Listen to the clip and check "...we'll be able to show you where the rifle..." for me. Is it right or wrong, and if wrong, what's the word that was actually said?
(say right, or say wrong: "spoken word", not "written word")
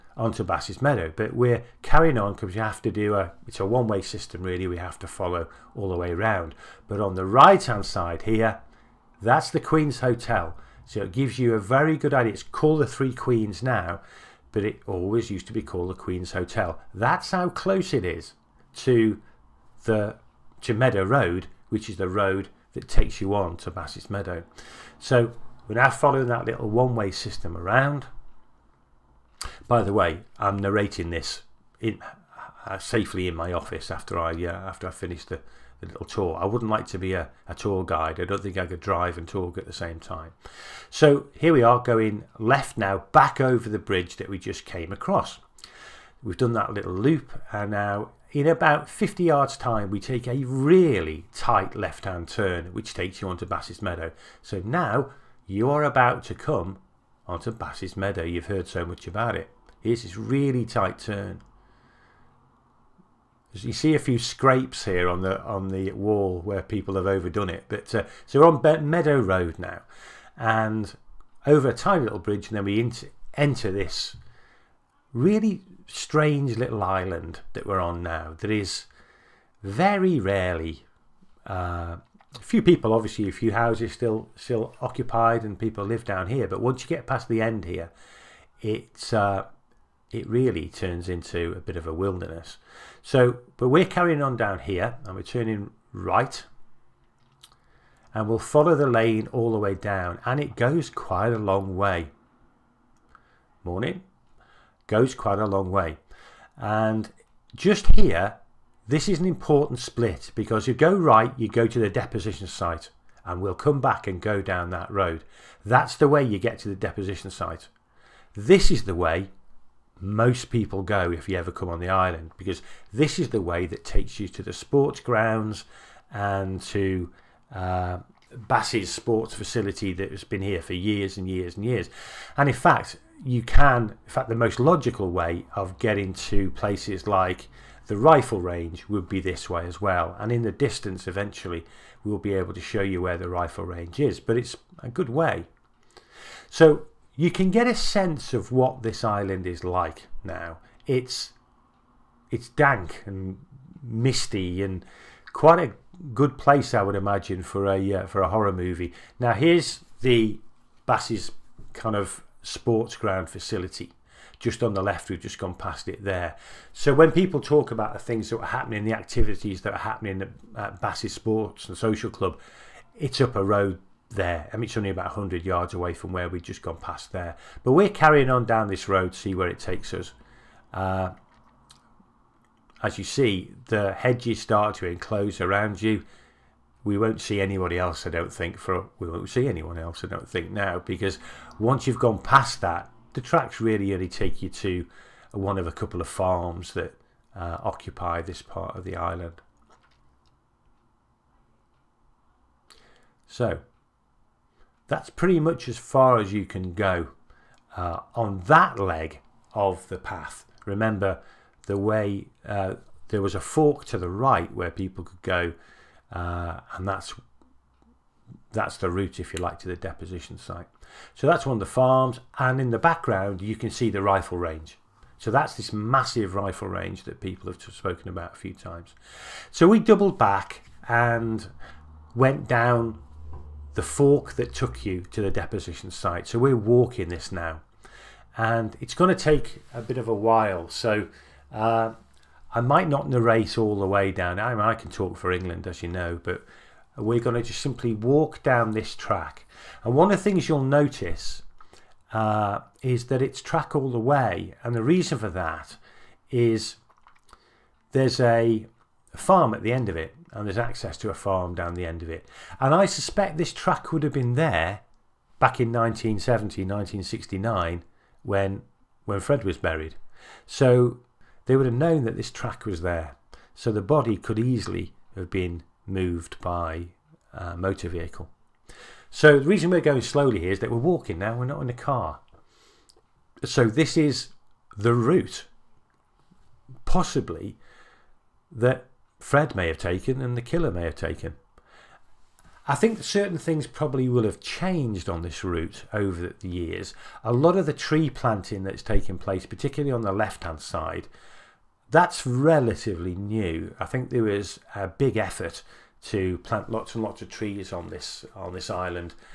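right.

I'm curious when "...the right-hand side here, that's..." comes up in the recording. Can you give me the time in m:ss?
0:07.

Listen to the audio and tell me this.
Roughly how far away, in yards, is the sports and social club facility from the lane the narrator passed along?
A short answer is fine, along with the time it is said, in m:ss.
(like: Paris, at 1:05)
100 yards, at 2:55.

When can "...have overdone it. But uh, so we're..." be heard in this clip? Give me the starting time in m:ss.
1:06.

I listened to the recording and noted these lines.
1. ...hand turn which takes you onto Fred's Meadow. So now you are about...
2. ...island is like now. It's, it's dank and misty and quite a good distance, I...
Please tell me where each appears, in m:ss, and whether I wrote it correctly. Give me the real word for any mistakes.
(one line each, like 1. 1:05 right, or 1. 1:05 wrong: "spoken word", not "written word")
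1. 0:52 wrong: "Bass", not "Fred"
2. 2:29 wrong: "place", not "distance".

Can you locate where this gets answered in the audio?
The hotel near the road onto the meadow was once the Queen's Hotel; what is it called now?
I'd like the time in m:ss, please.
0:12.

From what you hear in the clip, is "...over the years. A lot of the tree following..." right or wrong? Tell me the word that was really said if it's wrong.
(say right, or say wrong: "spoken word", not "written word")
wrong: "planting", not "following".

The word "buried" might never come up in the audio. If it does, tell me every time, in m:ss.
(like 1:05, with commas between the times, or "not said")
4:29.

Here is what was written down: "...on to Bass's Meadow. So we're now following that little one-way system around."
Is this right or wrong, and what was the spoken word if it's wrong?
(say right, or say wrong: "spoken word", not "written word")
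right.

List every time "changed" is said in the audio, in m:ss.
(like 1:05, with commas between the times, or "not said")
4:54.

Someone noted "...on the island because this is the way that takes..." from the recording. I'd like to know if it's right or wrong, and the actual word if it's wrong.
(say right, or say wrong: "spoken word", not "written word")
right.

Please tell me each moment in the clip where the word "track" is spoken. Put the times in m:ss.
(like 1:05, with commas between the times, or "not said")
3:13, 4:08, 4:13, 4:23, 4:32.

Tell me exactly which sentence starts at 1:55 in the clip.
That's the way you get to the deposition site.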